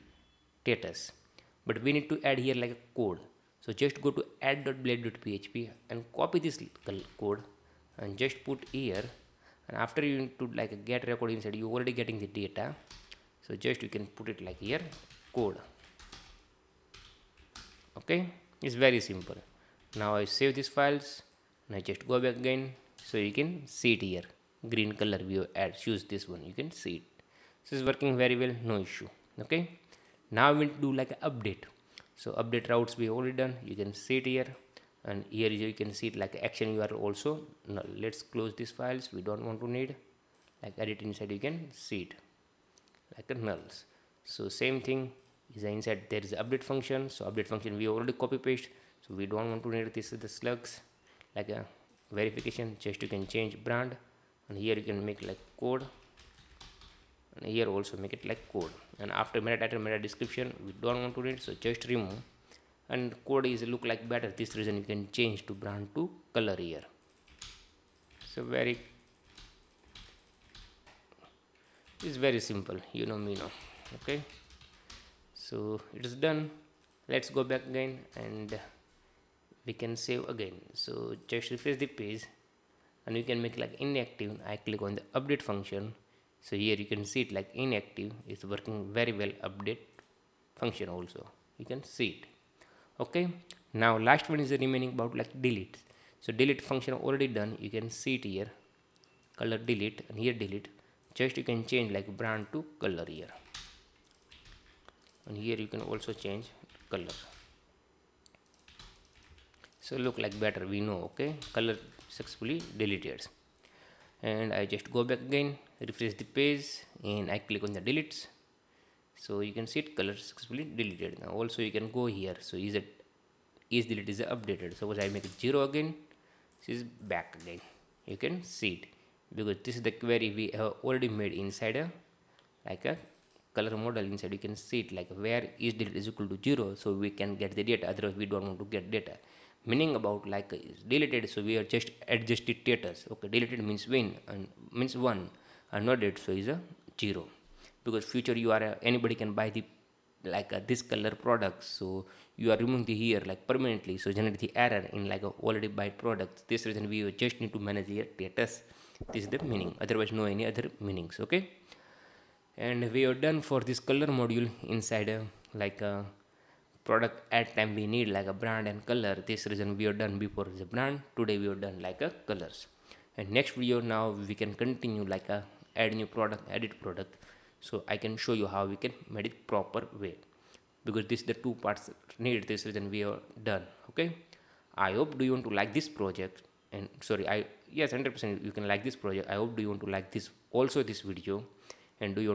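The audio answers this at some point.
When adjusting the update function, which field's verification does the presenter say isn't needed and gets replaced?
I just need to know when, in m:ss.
0:50.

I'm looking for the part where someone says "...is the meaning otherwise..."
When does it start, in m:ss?
2:39.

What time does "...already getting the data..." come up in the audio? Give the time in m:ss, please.
0:11.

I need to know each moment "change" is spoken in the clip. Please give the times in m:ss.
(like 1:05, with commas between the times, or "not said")
0:53, 1:05, 1:41, 1:46.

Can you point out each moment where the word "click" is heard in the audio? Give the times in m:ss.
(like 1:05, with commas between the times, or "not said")
1:24, 1:57.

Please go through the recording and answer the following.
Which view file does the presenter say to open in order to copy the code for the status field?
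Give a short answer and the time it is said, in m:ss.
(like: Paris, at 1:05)
add.blade.php, at 0:04.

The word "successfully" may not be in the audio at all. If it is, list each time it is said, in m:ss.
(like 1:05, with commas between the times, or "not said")
1:52, 2:00.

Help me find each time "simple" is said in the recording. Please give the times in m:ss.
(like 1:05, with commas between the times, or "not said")
0:18, 1:12.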